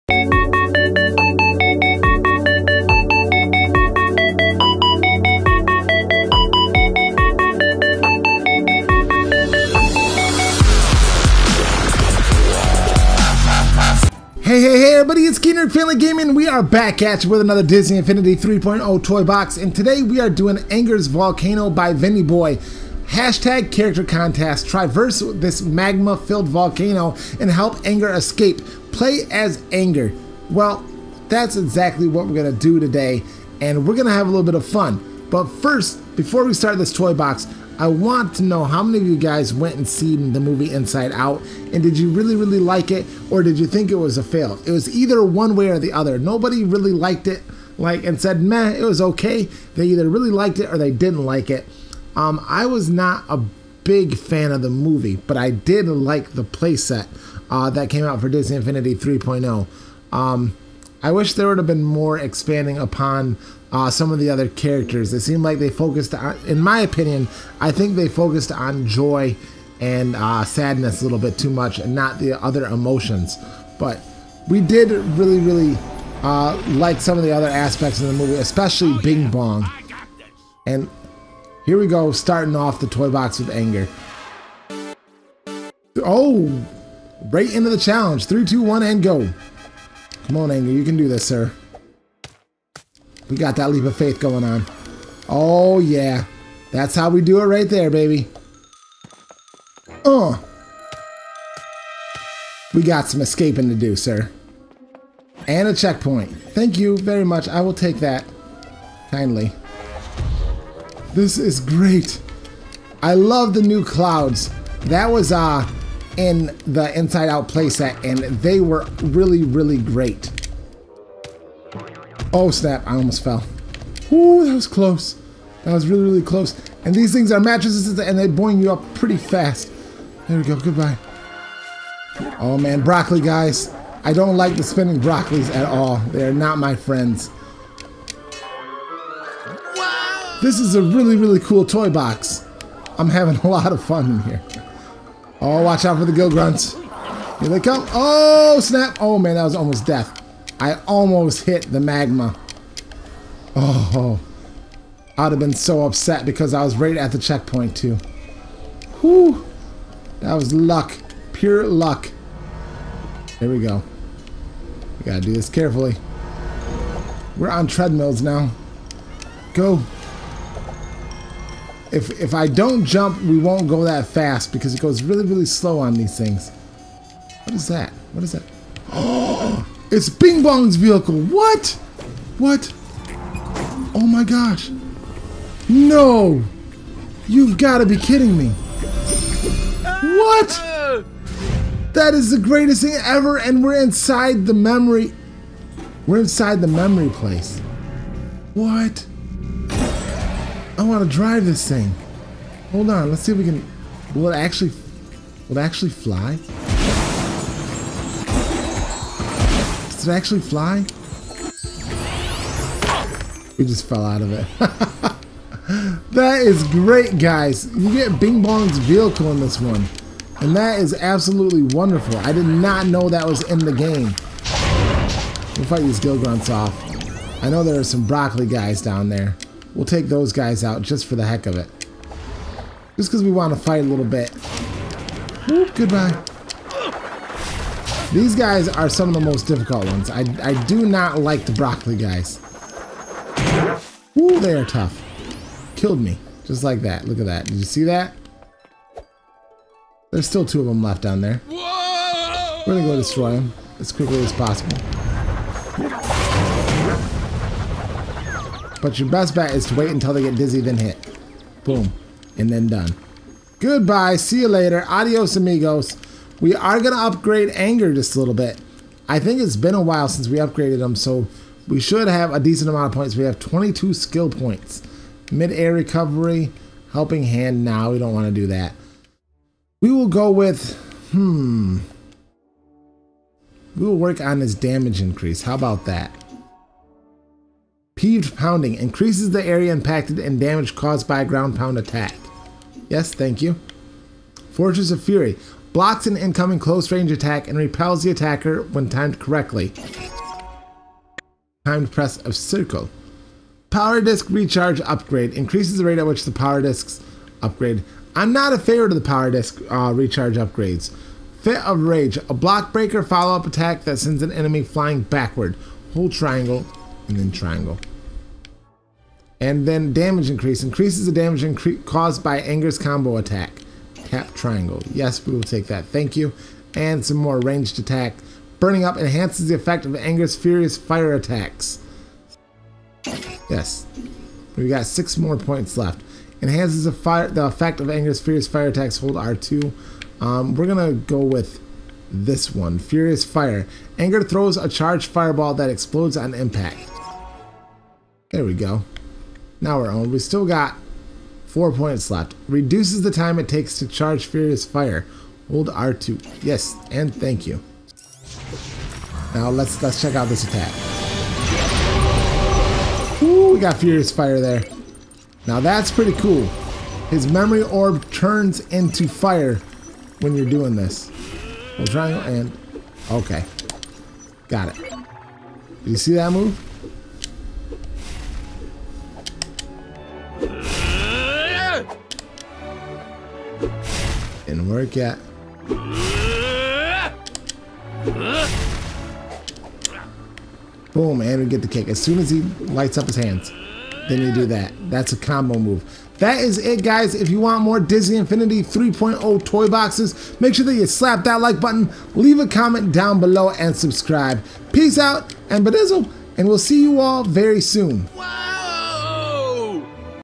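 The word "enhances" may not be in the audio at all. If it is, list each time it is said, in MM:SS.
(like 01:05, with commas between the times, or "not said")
05:28, 05:36.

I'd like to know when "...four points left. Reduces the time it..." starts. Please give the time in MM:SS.
05:51.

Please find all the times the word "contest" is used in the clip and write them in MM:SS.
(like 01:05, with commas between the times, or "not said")
00:24.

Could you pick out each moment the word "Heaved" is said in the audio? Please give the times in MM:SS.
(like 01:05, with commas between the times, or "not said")
04:48.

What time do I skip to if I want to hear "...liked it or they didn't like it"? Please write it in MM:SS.
00:50.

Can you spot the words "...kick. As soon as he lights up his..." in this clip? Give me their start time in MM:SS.
06:31.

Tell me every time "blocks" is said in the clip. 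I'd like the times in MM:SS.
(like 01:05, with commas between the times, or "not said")
04:55, 05:12.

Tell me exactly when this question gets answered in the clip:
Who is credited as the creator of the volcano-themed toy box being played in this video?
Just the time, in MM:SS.
00:21.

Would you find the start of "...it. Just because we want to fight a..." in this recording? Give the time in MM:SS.
03:51.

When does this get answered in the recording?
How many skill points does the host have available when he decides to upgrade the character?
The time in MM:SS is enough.
04:33.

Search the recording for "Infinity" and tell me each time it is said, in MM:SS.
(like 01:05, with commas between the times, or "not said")
00:17, 00:58, 06:38.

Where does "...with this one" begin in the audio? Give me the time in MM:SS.
05:41.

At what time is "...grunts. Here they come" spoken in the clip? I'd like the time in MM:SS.
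02:26.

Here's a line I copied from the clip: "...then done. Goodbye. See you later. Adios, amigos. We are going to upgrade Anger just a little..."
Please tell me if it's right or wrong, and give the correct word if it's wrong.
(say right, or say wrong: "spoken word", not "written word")
right.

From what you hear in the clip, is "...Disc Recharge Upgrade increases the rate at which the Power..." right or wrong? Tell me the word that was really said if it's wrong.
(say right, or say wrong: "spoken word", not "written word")
right.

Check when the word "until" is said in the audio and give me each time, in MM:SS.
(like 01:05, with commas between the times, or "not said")
04:19.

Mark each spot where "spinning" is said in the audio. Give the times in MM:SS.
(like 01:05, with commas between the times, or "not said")
02:14.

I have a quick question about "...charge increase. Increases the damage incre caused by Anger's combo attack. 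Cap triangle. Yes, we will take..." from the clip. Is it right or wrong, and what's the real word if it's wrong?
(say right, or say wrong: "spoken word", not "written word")
wrong: "damage", not "charge".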